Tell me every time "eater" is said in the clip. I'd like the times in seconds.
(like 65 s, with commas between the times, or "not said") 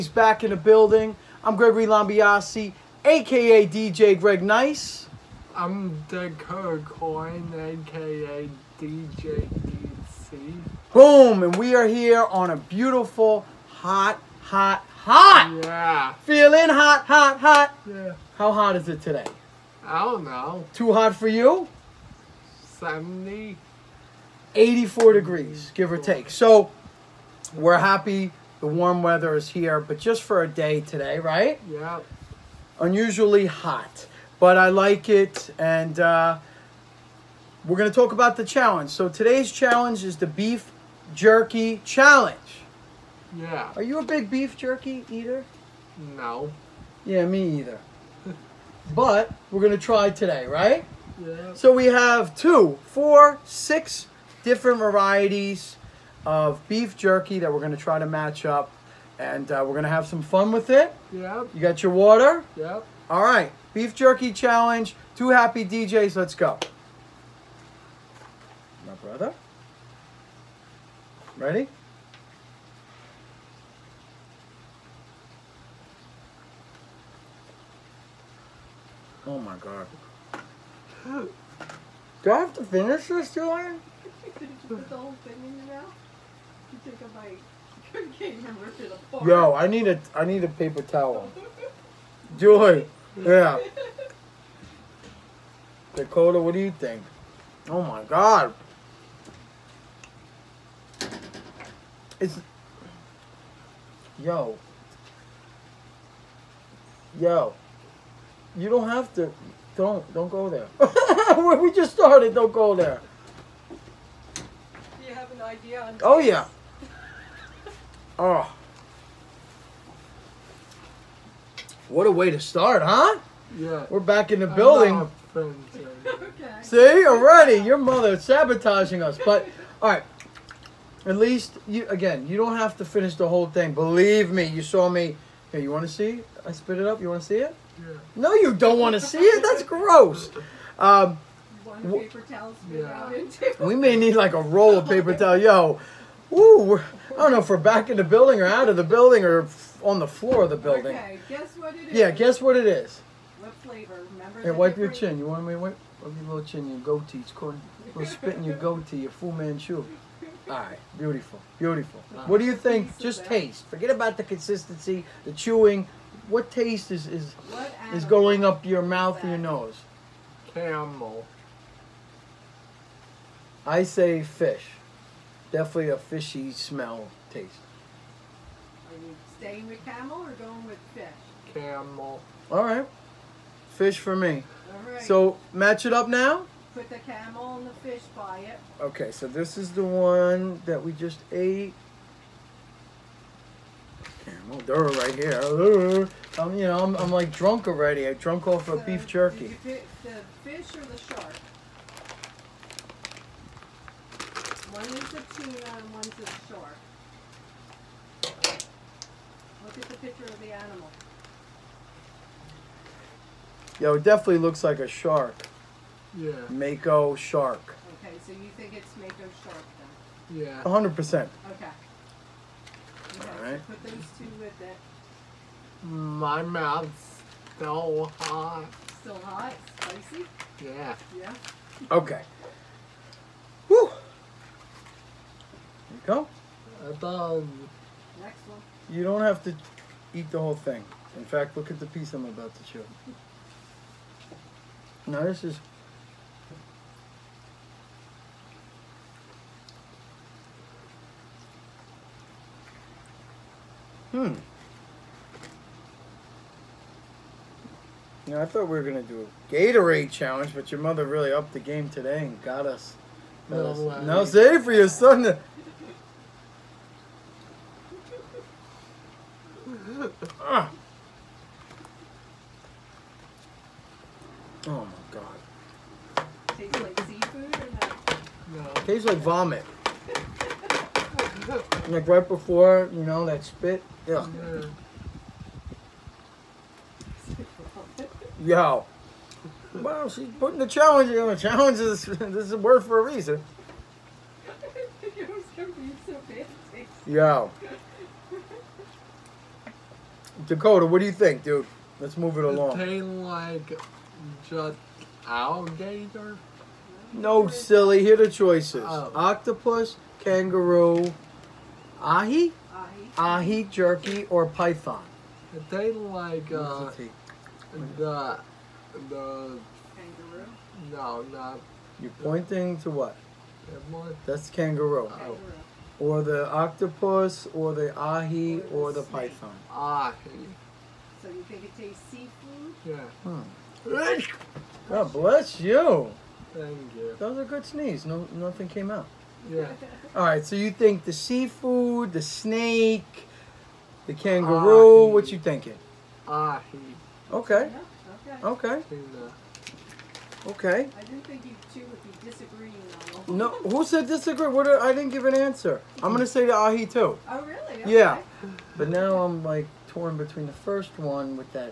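45 s.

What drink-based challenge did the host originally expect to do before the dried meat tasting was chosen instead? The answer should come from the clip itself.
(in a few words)
Gatorade challenge.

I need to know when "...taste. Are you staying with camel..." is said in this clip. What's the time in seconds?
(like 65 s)
177 s.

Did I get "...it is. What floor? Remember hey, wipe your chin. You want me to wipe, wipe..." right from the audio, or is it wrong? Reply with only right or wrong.
wrong.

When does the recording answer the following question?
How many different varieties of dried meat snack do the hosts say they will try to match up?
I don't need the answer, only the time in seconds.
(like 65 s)
53 s.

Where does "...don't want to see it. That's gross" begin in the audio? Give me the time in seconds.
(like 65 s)
138 s.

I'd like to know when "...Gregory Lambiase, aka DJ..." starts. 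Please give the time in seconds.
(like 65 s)
1 s.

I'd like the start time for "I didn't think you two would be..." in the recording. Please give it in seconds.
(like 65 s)
350 s.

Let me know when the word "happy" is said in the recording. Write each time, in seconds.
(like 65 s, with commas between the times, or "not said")
27 s, 65 s.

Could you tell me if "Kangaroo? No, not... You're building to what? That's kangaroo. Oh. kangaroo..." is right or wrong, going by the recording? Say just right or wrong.
wrong.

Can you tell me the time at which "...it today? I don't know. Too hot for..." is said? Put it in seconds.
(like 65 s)
18 s.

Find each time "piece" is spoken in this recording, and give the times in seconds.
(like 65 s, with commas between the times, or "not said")
241 s.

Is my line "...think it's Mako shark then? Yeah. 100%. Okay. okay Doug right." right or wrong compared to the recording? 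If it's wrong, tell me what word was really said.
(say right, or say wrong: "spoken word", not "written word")
wrong: "All", not "Doug".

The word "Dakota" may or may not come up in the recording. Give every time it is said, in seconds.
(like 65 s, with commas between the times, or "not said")
95 s, 300 s.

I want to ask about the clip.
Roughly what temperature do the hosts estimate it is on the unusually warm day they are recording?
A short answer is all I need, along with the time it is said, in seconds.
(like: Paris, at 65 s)
84 degrees, at 24 s.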